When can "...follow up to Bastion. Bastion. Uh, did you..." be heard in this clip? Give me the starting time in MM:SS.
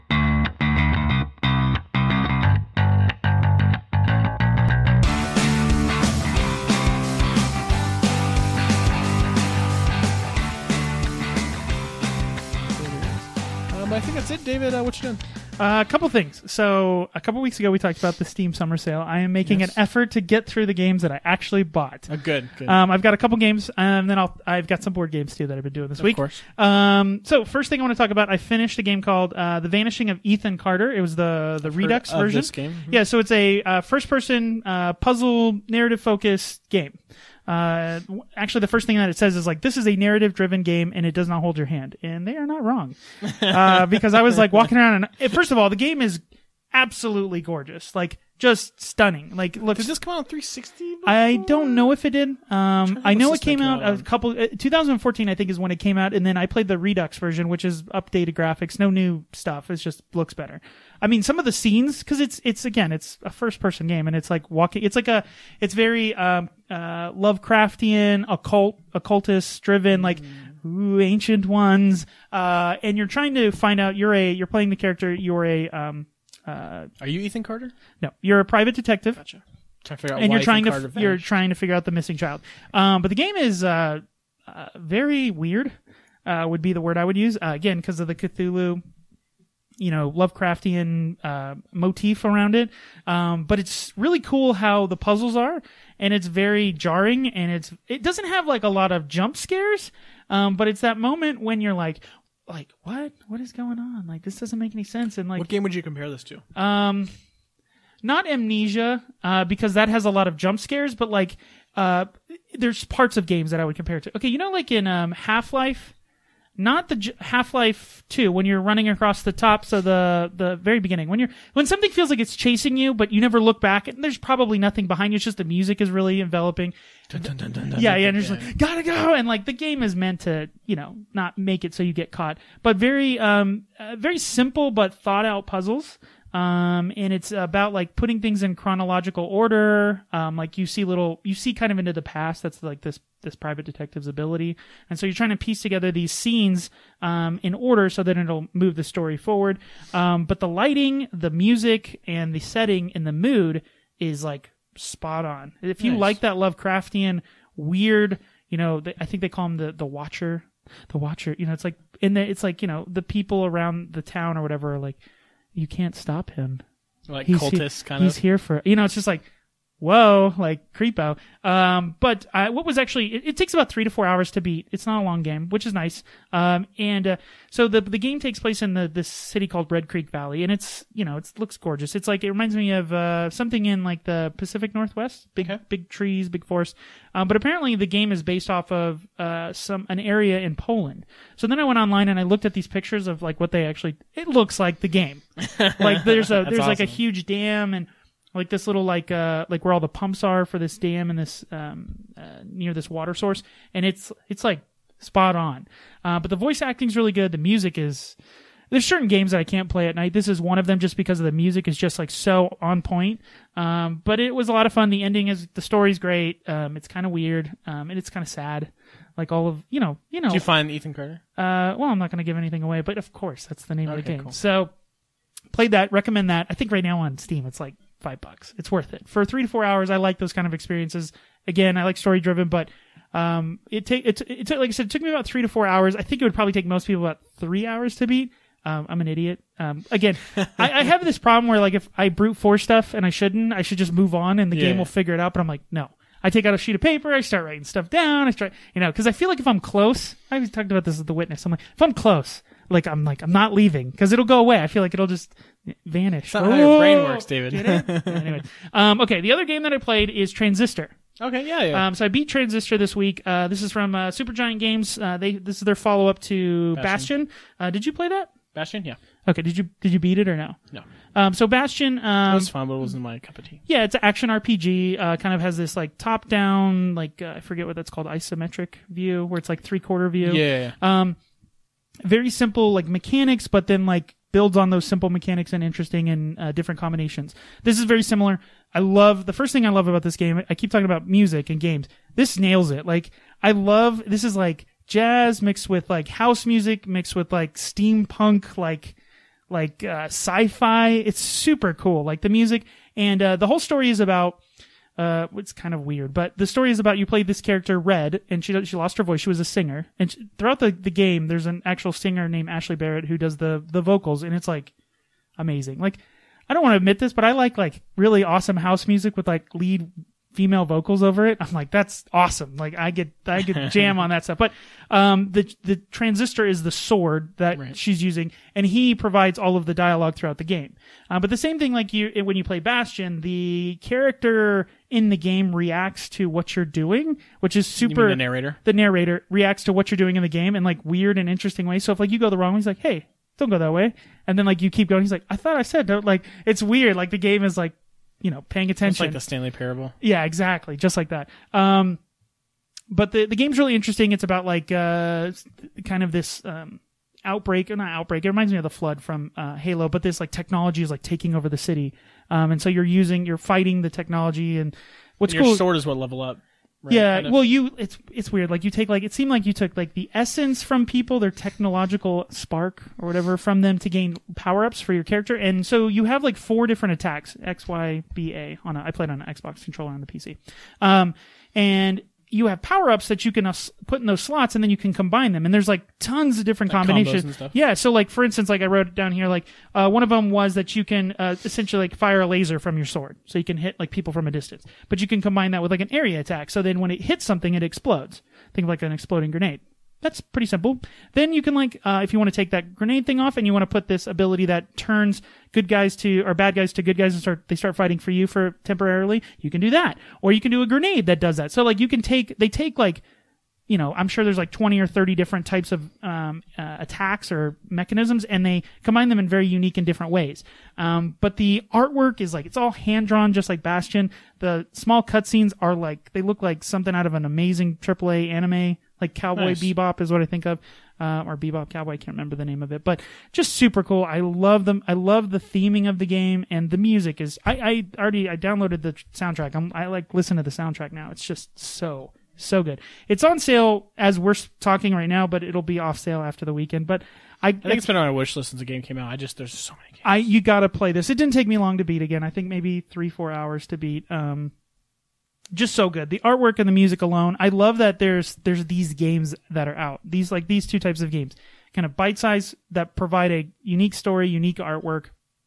04:25.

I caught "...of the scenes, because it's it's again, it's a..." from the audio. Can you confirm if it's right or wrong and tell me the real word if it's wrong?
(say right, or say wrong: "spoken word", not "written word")
right.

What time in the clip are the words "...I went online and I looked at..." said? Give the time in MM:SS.
03:11.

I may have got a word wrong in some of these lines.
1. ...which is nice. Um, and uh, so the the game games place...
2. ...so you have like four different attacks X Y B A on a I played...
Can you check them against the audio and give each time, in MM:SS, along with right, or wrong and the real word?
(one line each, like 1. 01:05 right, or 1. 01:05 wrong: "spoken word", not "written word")
1. 02:55 wrong: "takes", not "games"
2. 06:15 right.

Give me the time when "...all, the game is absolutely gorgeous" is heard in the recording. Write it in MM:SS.
00:45.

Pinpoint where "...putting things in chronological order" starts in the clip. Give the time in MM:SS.
02:17.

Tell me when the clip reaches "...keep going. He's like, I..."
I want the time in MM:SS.
05:44.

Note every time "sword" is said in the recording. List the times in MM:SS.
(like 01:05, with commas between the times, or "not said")
05:26, 06:05, 06:32.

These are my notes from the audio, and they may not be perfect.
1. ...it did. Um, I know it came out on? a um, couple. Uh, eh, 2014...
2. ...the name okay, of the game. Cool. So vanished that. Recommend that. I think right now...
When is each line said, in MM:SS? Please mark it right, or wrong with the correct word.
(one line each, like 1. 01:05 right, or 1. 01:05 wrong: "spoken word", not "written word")
1. 00:52 right
2. 03:43 wrong: "played", not "vanished".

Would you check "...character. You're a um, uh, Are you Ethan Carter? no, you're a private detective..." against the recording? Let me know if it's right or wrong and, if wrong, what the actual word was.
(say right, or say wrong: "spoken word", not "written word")
right.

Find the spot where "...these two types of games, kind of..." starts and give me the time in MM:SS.
07:40.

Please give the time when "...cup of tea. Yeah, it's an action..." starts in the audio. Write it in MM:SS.
04:33.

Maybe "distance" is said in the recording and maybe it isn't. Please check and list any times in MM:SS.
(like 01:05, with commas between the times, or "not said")
06:34.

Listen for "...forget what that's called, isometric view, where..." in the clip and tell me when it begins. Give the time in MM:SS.
04:37.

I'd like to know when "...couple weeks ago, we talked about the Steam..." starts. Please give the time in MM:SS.
00:17.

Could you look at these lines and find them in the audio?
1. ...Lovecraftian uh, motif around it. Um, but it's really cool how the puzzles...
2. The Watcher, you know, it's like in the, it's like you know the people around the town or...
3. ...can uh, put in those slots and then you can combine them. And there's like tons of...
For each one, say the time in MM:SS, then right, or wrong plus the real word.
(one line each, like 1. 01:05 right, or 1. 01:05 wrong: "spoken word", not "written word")
1. 01:30 right
2. 02:40 right
3. 06:23 right.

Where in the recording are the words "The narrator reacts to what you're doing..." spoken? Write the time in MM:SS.
05:38.